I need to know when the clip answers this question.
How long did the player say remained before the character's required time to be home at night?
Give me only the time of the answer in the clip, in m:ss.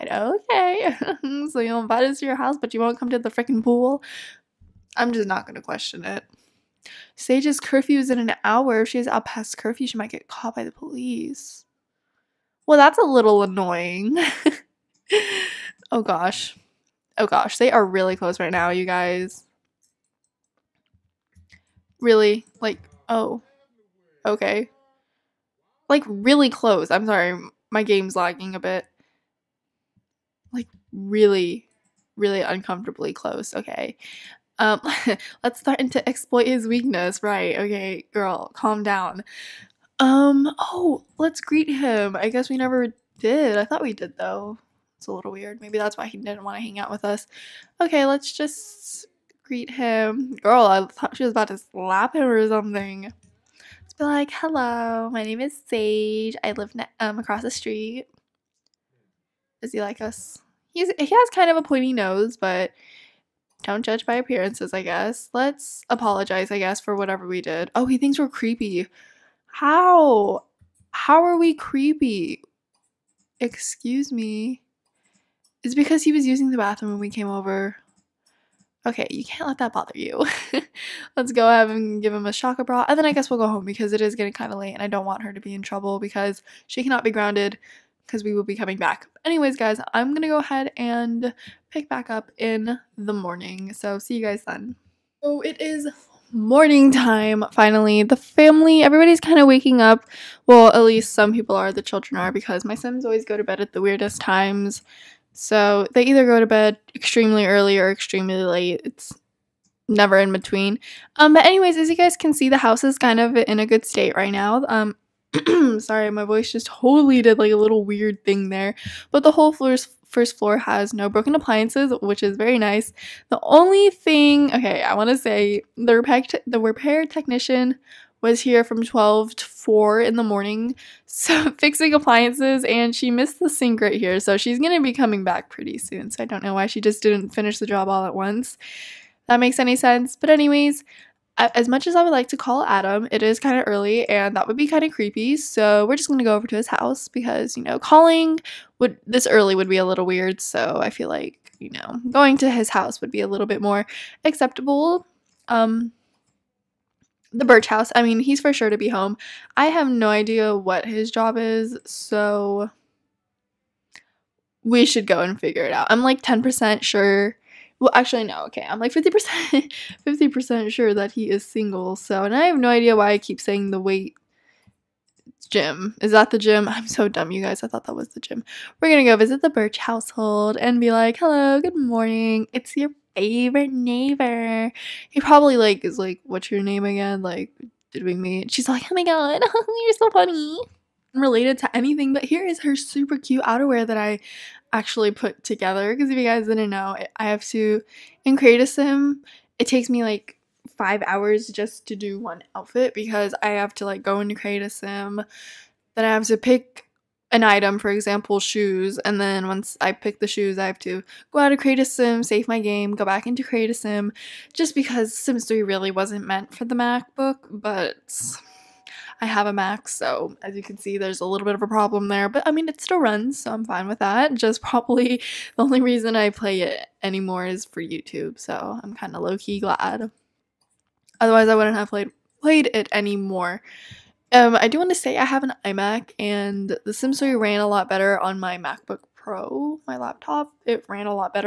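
0:08.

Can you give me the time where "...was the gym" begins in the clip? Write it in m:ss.
2:57.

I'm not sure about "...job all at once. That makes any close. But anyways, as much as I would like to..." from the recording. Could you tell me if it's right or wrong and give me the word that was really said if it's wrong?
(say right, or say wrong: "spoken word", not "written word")
wrong: "sense", not "close".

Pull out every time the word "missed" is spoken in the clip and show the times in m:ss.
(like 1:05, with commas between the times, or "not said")
2:13.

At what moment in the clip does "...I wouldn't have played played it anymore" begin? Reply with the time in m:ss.
3:51.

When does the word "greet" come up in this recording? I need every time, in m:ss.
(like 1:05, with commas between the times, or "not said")
0:41, 0:49.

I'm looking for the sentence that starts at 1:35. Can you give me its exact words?
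So it is morning time finally.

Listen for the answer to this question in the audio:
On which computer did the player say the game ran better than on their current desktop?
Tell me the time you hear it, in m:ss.
3:58.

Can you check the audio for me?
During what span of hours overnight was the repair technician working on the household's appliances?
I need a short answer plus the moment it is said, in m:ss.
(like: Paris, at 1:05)
12 to 4, at 2:08.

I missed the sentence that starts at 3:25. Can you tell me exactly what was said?
Then I have to pick an item, for example, shoes.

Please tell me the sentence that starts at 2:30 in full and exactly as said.
So I feel like, you know, going to his house would be a little bit more acceptable.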